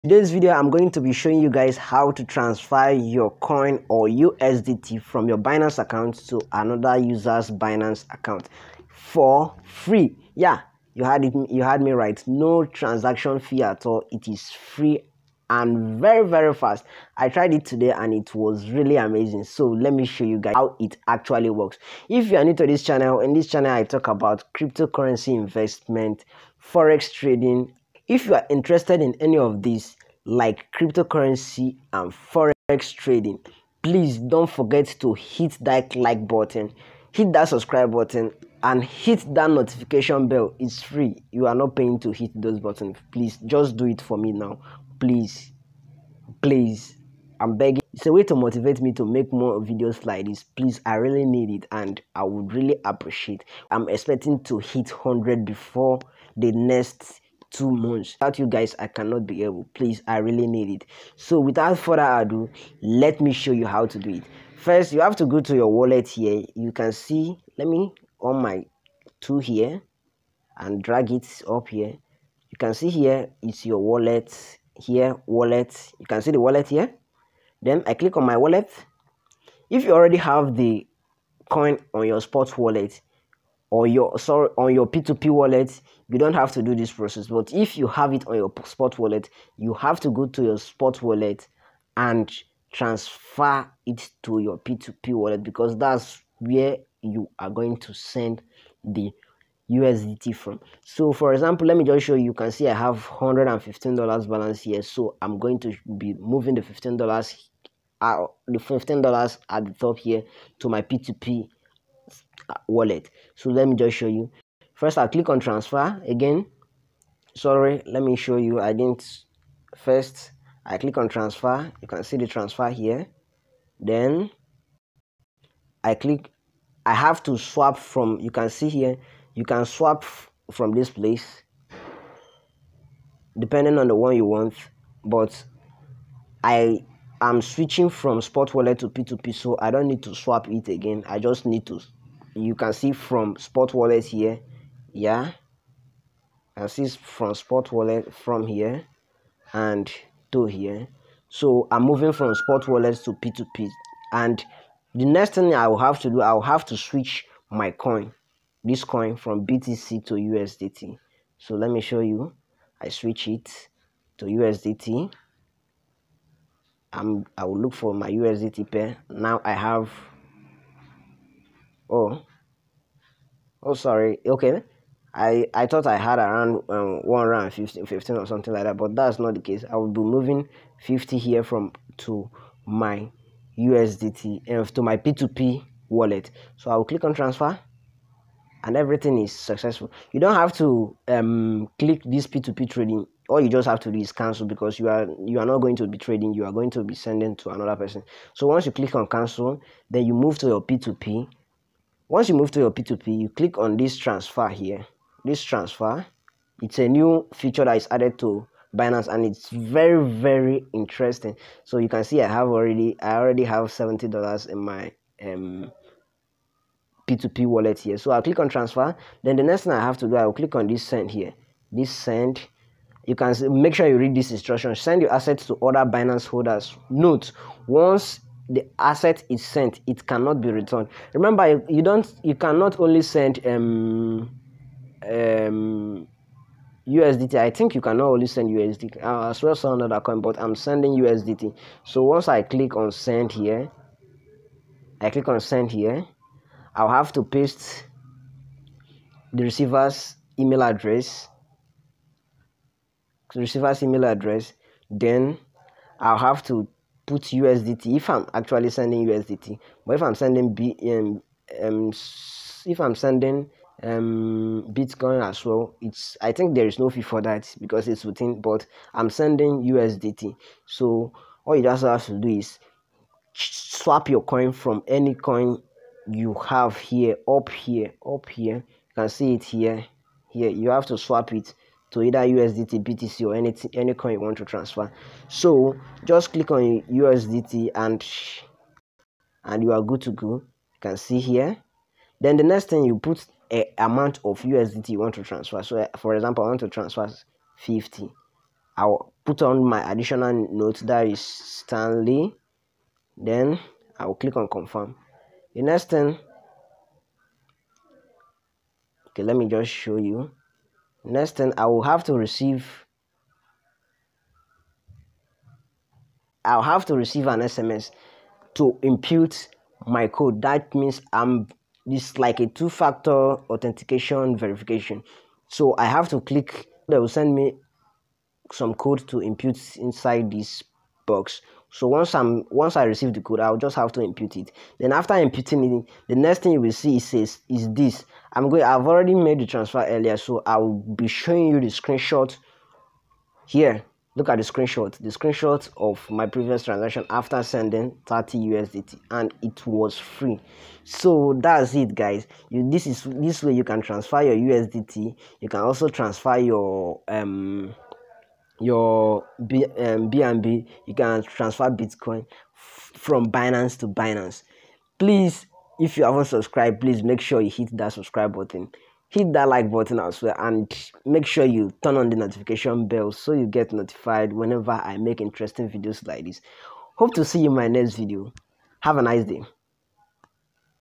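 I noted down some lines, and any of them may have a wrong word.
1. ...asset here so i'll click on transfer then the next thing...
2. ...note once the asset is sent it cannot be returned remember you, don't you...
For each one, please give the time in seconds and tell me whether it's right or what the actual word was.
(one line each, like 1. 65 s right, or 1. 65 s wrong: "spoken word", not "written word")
1. 217 s wrong: "wallet", not "asset"
2. 226 s right.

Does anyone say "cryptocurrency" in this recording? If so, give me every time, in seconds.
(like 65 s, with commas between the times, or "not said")
24 s, 30 s.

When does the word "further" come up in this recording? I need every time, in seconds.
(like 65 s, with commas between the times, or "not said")
61 s.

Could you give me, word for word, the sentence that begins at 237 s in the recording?
I think you cannot only send USDT.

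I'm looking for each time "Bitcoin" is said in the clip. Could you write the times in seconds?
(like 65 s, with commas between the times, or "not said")
264 s, 361 s.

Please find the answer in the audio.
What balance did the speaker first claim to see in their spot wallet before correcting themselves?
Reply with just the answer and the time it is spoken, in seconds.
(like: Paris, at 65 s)
$115, at 103 s.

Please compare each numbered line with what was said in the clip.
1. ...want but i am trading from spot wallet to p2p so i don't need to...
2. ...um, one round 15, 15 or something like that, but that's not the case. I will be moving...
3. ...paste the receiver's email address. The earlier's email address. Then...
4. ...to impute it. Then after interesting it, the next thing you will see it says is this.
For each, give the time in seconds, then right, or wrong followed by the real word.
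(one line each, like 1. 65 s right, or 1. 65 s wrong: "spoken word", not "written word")
1. 134 s wrong: "switching", not "trading"
2. 176 s right
3. 247 s wrong: "receiver", not "earlier"
4. 333 s wrong: "imputing", not "interesting".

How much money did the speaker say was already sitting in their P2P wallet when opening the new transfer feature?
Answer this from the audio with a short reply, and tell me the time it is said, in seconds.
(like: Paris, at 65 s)
$70, at 213 s.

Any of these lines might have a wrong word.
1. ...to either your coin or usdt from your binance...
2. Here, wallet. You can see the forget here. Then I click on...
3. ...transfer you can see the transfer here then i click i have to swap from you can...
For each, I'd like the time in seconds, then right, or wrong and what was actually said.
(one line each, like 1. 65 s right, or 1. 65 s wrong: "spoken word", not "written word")
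1. 2 s wrong: "transfer", not "either"
2. 74 s wrong: "wallet", not "forget"
3. 121 s right.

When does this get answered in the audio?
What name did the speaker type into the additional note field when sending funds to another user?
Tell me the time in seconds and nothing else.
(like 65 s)
301 s.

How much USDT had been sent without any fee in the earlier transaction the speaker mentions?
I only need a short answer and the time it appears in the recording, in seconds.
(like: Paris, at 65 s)
30 USDT, at 348 s.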